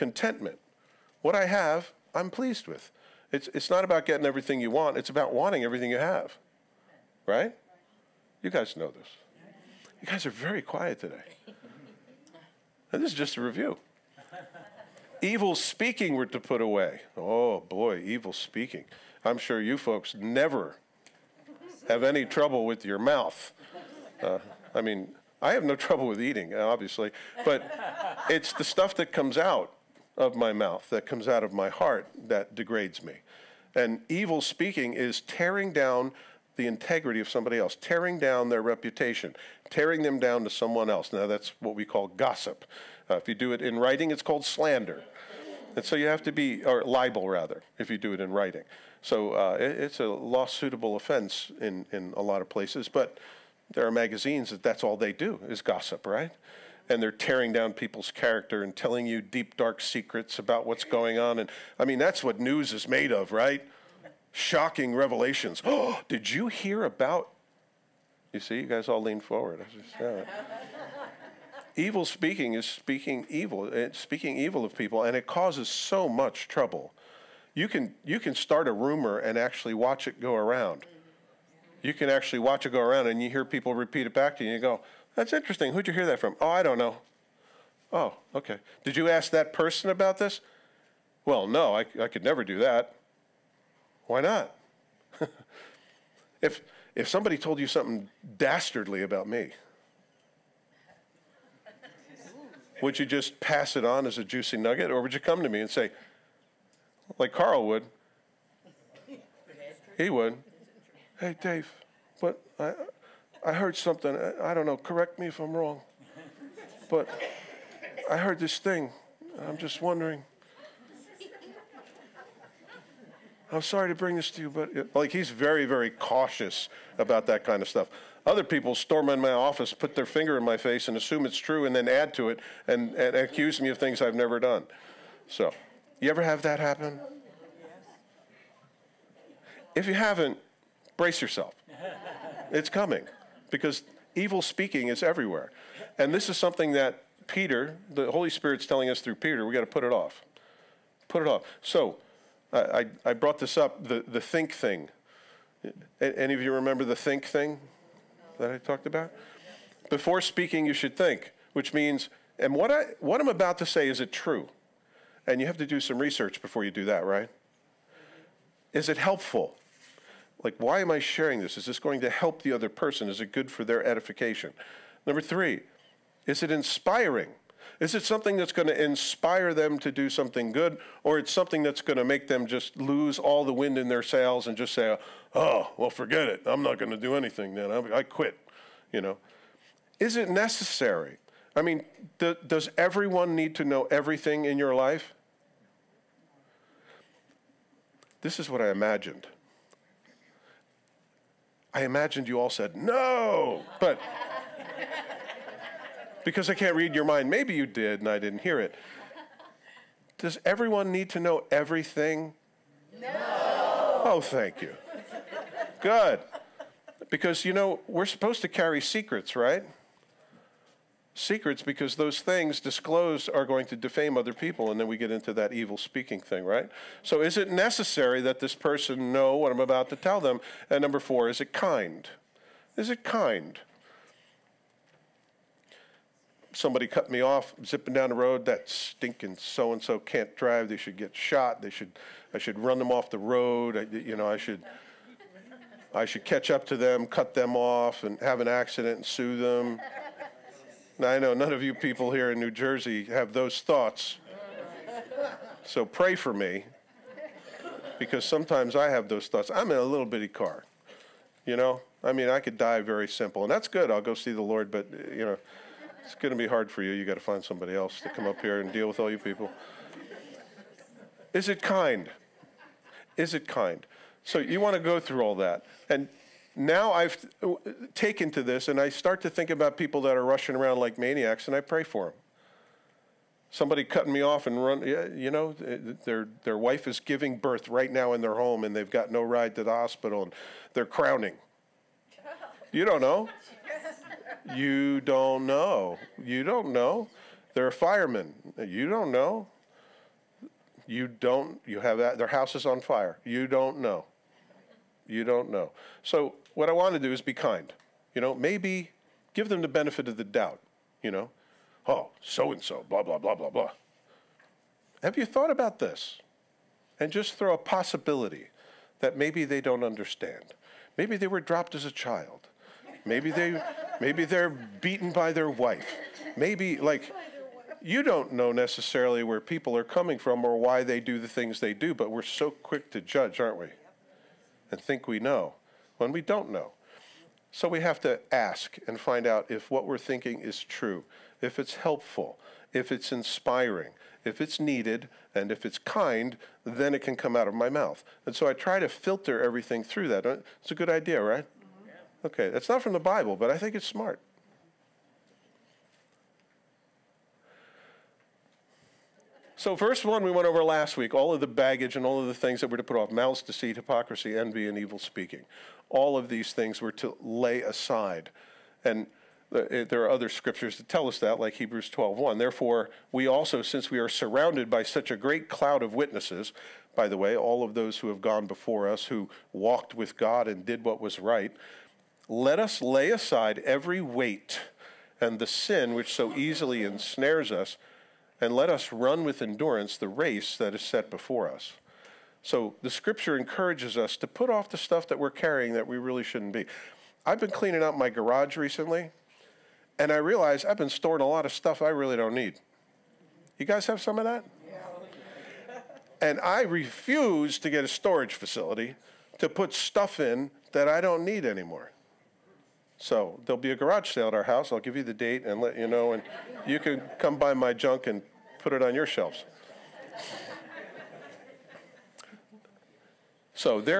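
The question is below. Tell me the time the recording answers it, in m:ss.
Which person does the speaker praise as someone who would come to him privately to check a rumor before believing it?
1:47.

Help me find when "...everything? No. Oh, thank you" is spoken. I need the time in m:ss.
3:31.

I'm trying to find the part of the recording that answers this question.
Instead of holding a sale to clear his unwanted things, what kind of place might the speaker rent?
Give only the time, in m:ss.
6:47.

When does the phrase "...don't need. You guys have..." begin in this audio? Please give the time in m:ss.
6:42.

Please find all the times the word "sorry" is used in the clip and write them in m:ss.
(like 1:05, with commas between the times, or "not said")
2:03.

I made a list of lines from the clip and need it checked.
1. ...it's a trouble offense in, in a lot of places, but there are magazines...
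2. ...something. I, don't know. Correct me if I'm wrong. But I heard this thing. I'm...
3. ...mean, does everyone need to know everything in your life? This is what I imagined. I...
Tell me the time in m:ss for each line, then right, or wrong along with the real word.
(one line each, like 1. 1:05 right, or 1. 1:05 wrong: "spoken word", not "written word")
1. 0:49 wrong: "lawsuitable", not "trouble"
2. 1:53 right
3. 3:11 right.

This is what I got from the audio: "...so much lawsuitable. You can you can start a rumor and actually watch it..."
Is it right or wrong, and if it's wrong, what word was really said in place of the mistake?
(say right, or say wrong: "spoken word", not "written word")
wrong: "trouble", not "lawsuitable".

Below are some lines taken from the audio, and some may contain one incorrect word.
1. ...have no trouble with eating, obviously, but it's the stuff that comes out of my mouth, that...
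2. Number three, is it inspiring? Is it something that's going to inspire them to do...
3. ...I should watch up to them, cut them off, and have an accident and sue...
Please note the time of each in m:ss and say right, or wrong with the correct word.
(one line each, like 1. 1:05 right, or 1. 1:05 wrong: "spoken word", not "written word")
1. 0:25 right
2. 2:55 right
3. 4:05 wrong: "catch", not "watch".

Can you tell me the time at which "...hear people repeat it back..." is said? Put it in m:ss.
1:23.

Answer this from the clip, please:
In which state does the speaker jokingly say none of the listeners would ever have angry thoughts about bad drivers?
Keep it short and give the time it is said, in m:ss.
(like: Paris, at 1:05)
New Jersey, at 4:12.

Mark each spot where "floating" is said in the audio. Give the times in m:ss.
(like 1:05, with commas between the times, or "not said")
not said.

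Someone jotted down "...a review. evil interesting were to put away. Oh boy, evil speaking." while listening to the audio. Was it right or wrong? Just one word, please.
wrong.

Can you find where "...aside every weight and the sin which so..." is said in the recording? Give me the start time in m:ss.
6:23.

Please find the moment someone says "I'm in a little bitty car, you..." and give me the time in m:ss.
4:19.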